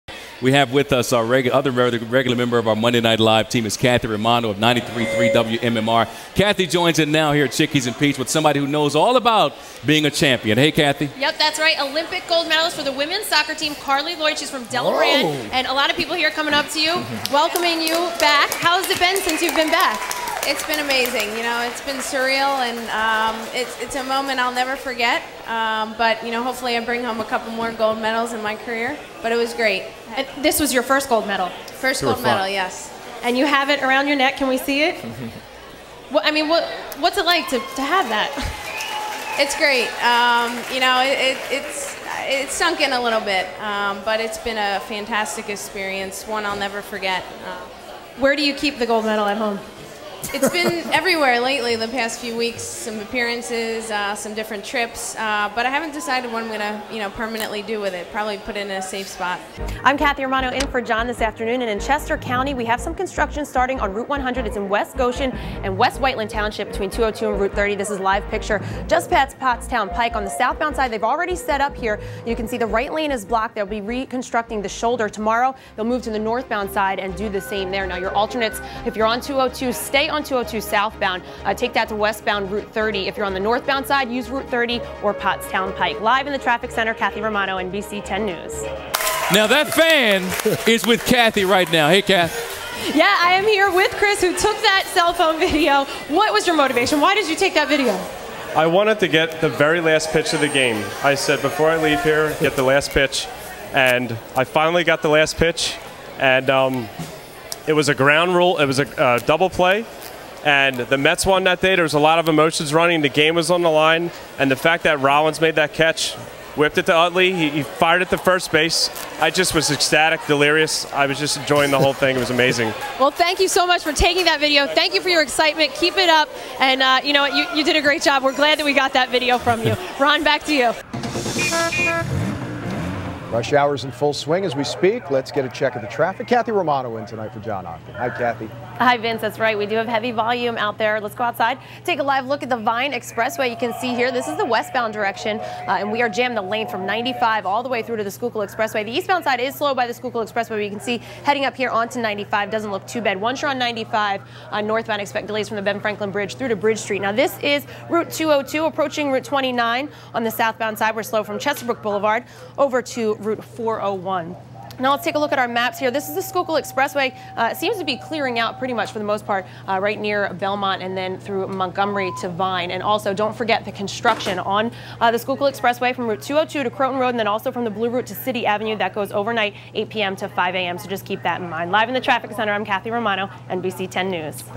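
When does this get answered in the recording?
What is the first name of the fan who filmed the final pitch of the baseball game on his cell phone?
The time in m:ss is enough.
1:33.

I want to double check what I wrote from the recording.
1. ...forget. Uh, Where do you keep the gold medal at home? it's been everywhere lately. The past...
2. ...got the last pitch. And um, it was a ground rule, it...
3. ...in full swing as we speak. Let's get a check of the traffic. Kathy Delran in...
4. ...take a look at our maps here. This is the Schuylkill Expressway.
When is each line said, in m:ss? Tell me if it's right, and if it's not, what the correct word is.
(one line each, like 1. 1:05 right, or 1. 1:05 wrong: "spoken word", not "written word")
1. 0:46 right
2. 1:44 right
3. 2:13 wrong: "Romano", not "Delran"
4. 2:45 right.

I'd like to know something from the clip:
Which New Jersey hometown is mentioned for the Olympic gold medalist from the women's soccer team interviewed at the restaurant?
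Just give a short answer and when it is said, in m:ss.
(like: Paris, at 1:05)
Delran, at 0:14.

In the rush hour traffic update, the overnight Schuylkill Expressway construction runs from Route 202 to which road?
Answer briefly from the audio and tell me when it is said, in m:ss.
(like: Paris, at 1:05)
Croton Road, at 2:56.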